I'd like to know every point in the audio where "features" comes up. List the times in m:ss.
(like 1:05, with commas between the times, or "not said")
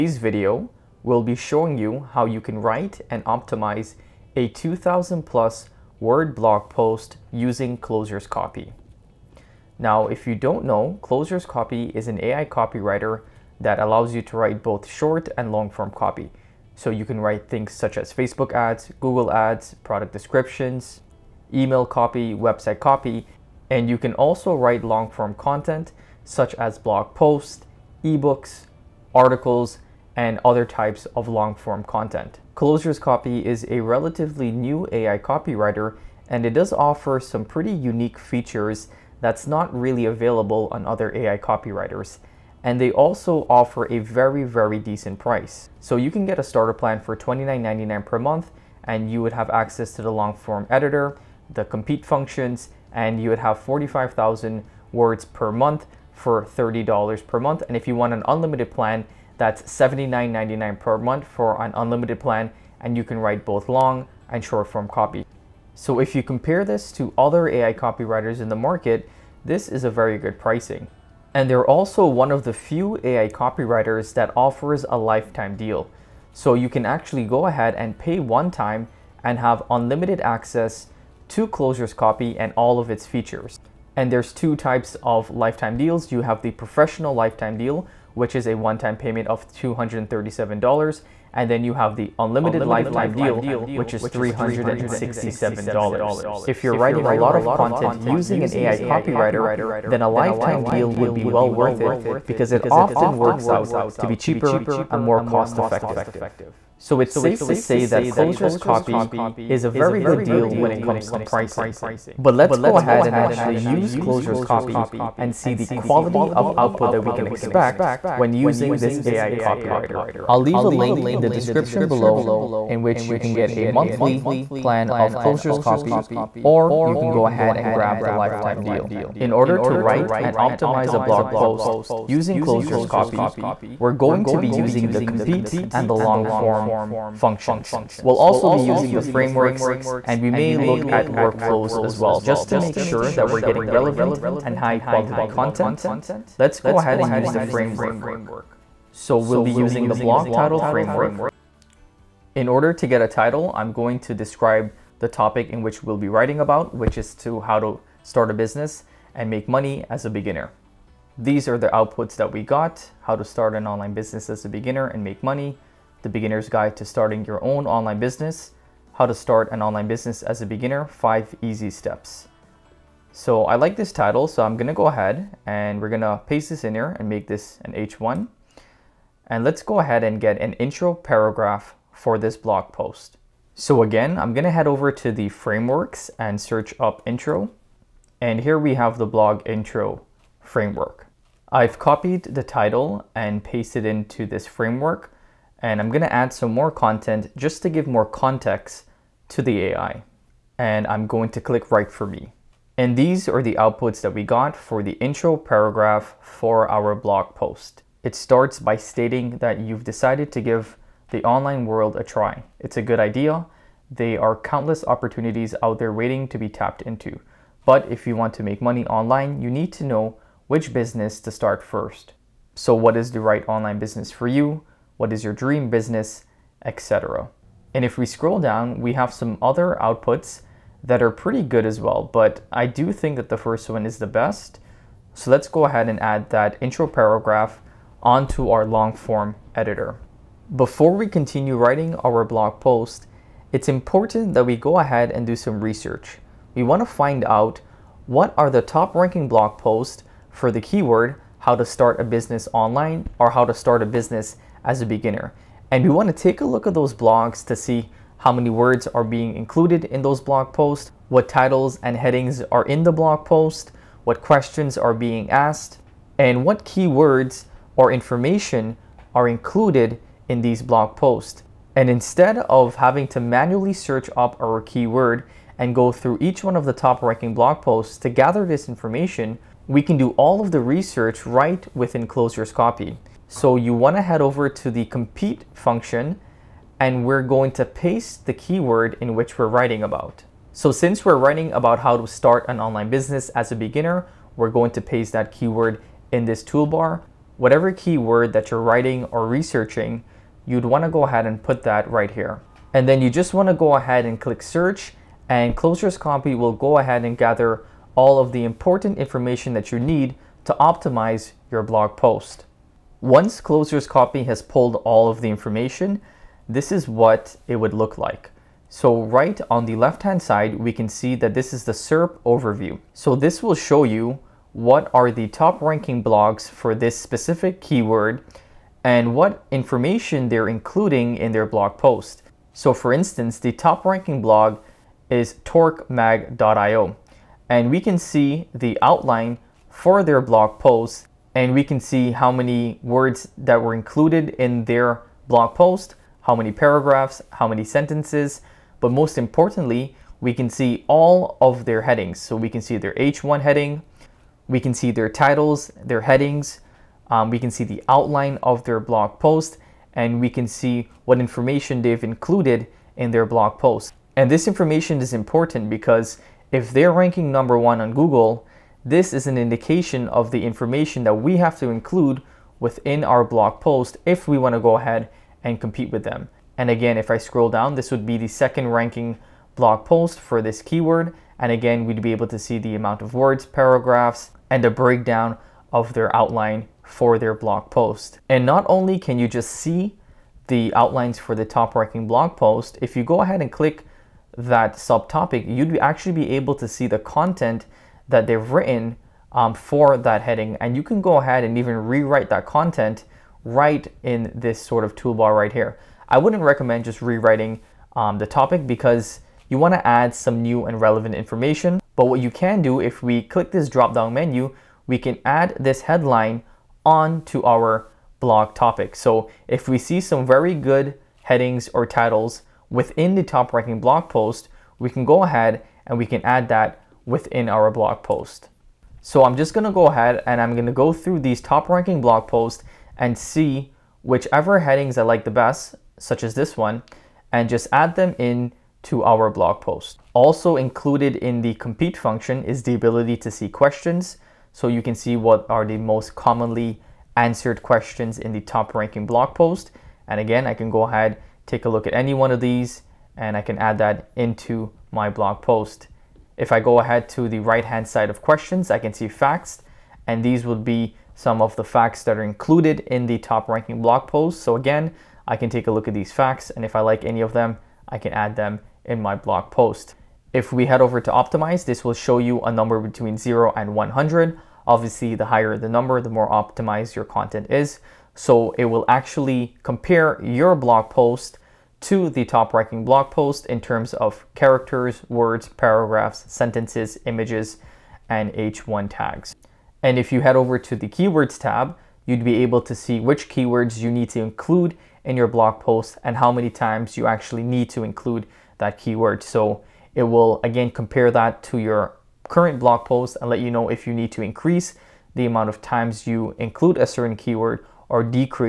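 0:38, 1:23.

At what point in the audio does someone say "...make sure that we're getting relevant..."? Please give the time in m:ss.
2:22.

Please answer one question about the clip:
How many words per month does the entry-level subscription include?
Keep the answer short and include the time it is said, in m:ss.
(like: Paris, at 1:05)
45,000, at 0:53.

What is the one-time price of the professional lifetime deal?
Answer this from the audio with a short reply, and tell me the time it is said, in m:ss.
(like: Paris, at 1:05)
$237, at 1:29.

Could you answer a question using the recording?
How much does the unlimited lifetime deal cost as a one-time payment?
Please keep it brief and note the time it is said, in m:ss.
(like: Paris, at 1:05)
$367, at 1:34.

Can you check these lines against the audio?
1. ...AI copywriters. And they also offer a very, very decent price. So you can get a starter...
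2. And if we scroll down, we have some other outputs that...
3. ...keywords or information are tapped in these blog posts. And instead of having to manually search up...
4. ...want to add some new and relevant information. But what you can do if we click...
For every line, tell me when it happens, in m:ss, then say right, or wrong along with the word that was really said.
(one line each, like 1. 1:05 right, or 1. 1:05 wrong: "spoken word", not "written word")
1. 0:41 right
2. 3:47 right
3. 4:26 wrong: "included", not "tapped"
4. 6:49 right.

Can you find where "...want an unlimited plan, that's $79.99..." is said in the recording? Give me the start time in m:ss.
0:57.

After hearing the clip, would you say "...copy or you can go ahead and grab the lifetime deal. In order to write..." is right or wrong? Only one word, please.
right.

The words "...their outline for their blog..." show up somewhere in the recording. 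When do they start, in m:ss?
6:25.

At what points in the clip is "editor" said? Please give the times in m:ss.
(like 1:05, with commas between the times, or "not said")
0:50, 3:59.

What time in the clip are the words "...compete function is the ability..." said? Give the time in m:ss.
7:21.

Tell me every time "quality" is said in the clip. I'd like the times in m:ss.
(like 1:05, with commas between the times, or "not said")
1:55, 2:24.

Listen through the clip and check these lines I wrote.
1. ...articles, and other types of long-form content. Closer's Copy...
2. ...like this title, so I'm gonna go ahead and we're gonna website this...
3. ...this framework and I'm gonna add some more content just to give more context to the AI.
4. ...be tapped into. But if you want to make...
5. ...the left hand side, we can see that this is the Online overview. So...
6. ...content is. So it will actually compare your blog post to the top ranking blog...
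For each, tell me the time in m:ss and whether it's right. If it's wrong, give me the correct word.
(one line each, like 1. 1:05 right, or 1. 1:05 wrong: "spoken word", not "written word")
1. 0:29 right
2. 2:53 wrong: "paste", not "website"
3. 3:14 right
4. 3:36 right
5. 5:19 wrong: "SERP", not "Online"
6. 7:57 right.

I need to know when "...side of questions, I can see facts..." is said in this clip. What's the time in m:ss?
7:37.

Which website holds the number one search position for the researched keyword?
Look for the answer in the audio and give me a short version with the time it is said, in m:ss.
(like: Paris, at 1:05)
torquemag.io, at 5:35.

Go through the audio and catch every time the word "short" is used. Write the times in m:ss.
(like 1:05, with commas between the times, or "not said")
0:14, 1:04.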